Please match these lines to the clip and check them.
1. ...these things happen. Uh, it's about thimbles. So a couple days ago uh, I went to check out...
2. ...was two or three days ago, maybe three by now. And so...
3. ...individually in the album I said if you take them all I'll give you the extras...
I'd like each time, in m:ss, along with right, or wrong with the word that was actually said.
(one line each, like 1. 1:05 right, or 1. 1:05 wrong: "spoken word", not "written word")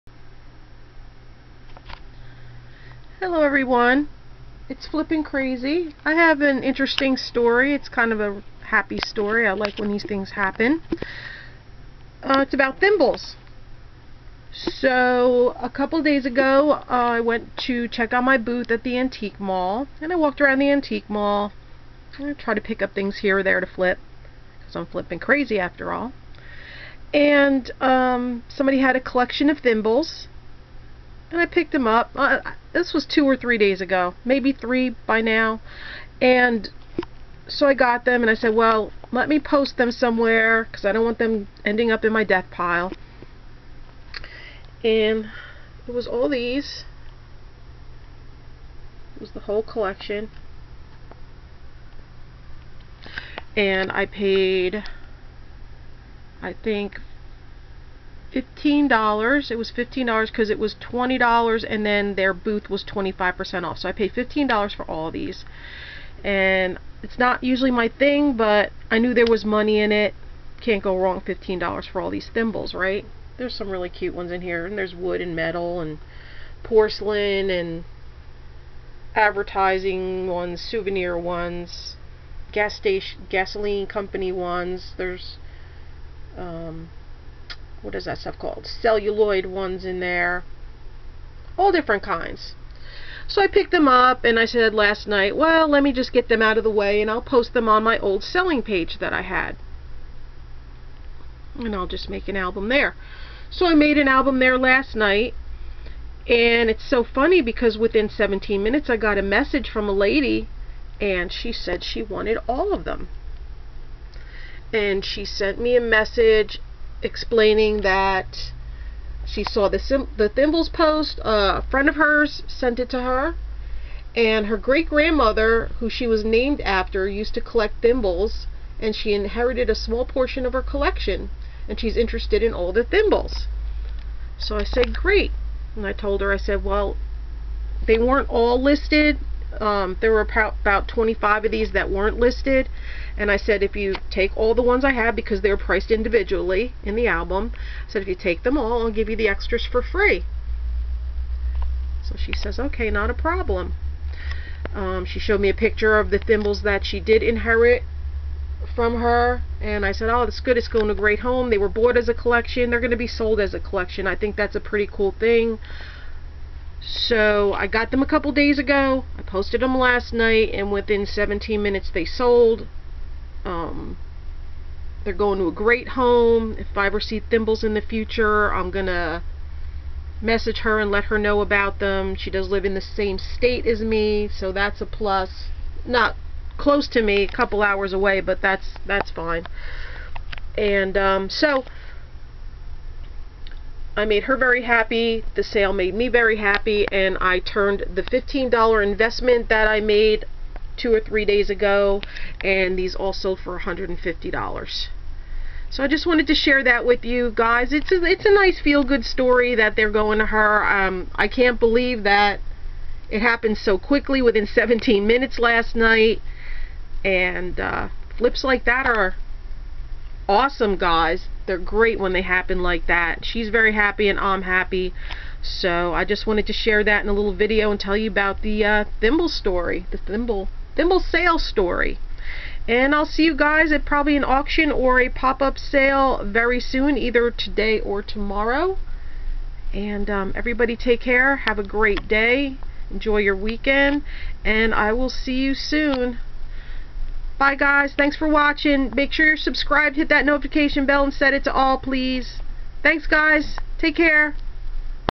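1. 0:09 right
2. 0:32 right
3. 2:25 right.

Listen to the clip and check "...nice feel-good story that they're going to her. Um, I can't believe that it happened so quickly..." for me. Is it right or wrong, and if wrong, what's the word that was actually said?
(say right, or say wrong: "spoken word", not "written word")
right.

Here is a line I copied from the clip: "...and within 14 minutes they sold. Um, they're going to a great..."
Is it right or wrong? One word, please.
wrong.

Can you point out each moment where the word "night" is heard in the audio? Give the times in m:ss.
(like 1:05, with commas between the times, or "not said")
1:35, 1:44, 2:50, 3:35.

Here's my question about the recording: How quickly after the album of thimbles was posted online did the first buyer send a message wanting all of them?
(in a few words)
17 minutes.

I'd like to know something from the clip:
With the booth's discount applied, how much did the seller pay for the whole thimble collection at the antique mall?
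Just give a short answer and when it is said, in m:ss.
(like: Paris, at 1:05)
$15, at 1:03.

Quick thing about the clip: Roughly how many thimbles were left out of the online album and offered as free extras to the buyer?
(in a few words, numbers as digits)
25.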